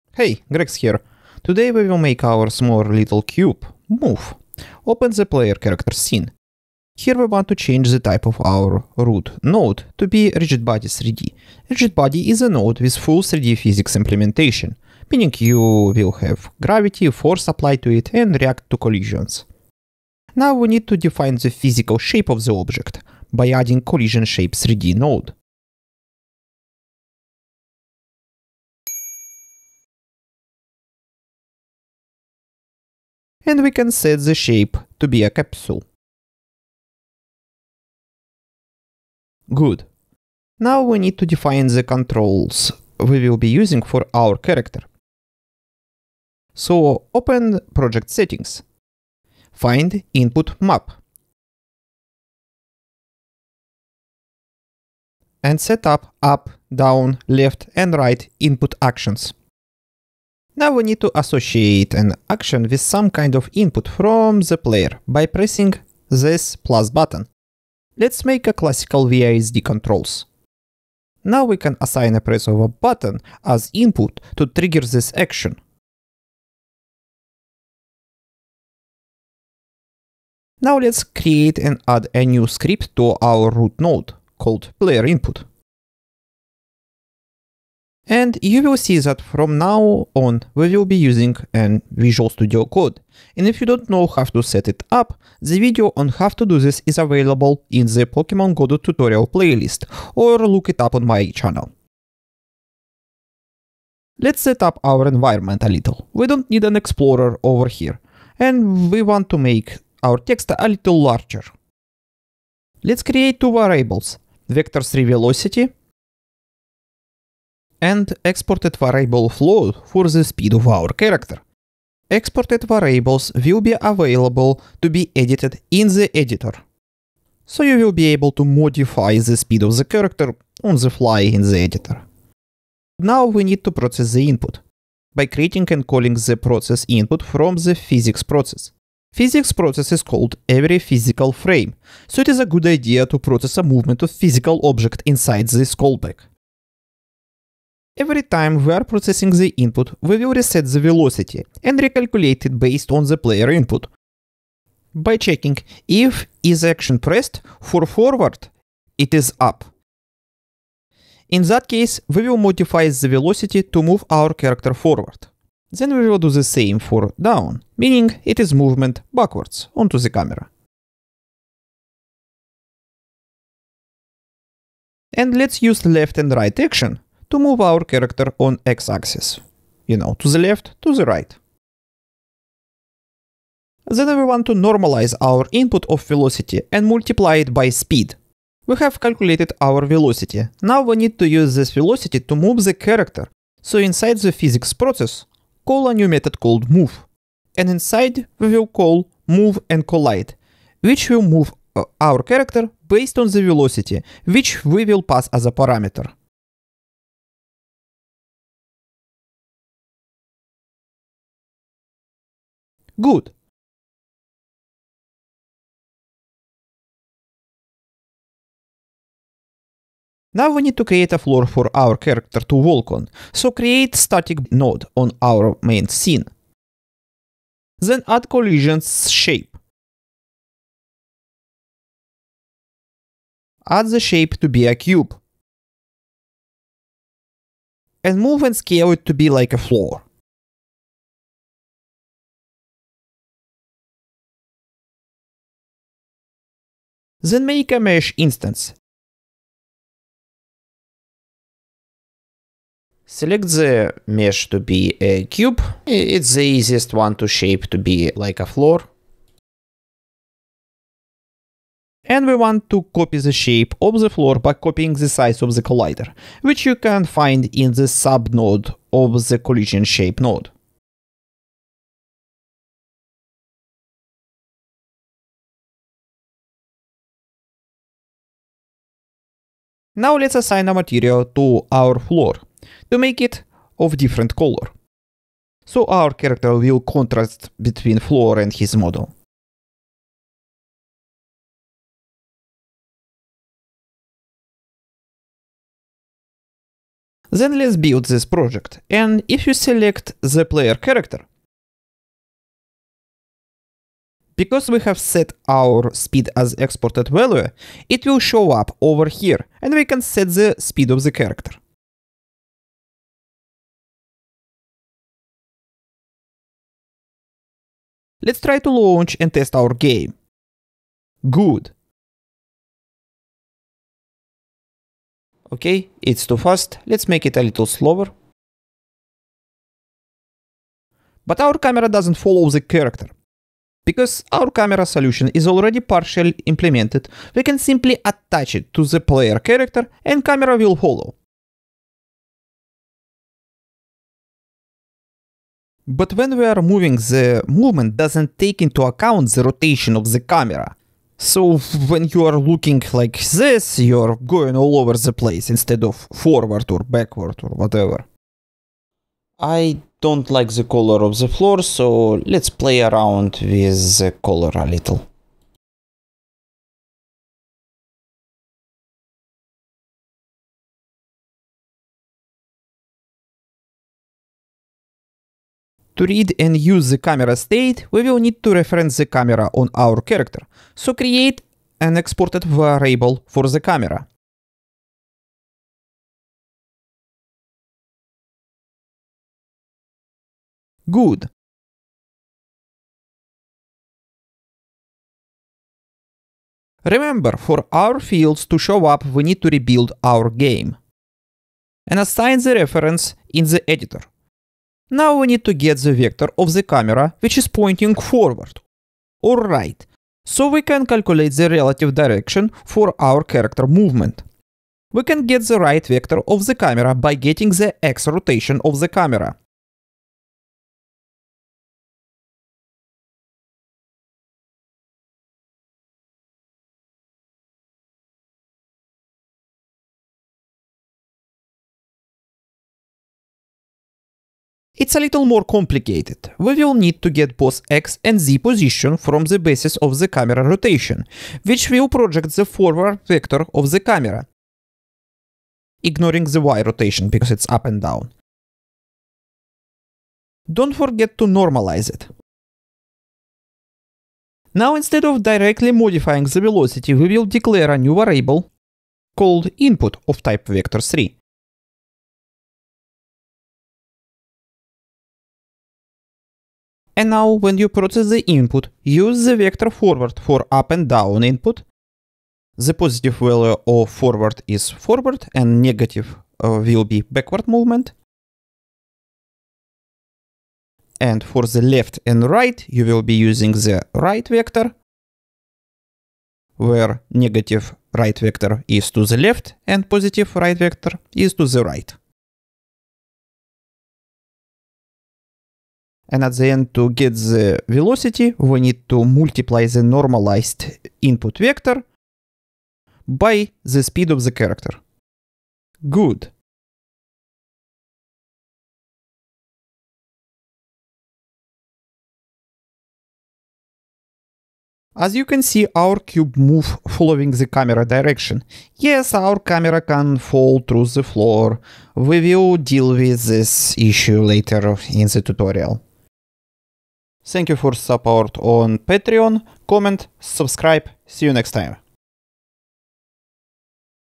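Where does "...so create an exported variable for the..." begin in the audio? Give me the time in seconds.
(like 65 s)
380 s.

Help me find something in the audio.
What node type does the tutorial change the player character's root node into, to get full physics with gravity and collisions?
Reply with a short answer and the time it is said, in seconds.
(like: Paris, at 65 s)
RigidBody3D, at 10 s.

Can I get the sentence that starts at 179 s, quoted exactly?
You know, to the left, to the right.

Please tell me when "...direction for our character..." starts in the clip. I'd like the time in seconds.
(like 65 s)
412 s.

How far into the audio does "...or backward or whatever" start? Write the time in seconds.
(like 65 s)
356 s.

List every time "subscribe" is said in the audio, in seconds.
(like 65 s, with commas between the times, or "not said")
530 s.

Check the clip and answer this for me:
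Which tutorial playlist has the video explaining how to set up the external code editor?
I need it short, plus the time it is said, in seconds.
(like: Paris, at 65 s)
Pokemon Go tutorial, at 98 s.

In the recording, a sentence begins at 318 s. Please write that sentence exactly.
Let's try to launch and test our game.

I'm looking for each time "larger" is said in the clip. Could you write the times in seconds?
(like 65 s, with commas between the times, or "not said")
111 s.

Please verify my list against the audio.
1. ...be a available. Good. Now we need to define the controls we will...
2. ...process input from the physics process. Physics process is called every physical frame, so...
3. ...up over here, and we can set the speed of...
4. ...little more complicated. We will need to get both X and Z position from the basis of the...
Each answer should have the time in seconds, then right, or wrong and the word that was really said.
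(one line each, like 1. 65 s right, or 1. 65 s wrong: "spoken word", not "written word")
1. 35 s wrong: "capsule", not "available"
2. 136 s right
3. 308 s right
4. 434 s right.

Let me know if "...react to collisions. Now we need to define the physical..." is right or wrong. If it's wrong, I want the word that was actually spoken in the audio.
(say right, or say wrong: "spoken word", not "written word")
right.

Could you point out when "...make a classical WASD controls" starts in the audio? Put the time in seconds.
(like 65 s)
68 s.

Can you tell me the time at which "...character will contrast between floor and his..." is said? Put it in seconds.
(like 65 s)
286 s.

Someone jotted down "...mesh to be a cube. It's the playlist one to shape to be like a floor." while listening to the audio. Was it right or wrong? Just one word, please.
wrong.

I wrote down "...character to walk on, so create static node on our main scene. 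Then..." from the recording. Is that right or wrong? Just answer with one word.
right.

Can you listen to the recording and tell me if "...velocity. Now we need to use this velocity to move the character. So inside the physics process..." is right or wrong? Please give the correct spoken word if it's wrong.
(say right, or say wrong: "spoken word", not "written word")
right.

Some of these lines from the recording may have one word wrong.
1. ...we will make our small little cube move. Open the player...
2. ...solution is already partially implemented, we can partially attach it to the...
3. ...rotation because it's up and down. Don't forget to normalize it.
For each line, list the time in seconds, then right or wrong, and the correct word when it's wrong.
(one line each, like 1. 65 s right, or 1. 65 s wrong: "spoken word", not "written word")
1. 1 s right
2. 334 s wrong: "simply", not "partially"
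3. 446 s right.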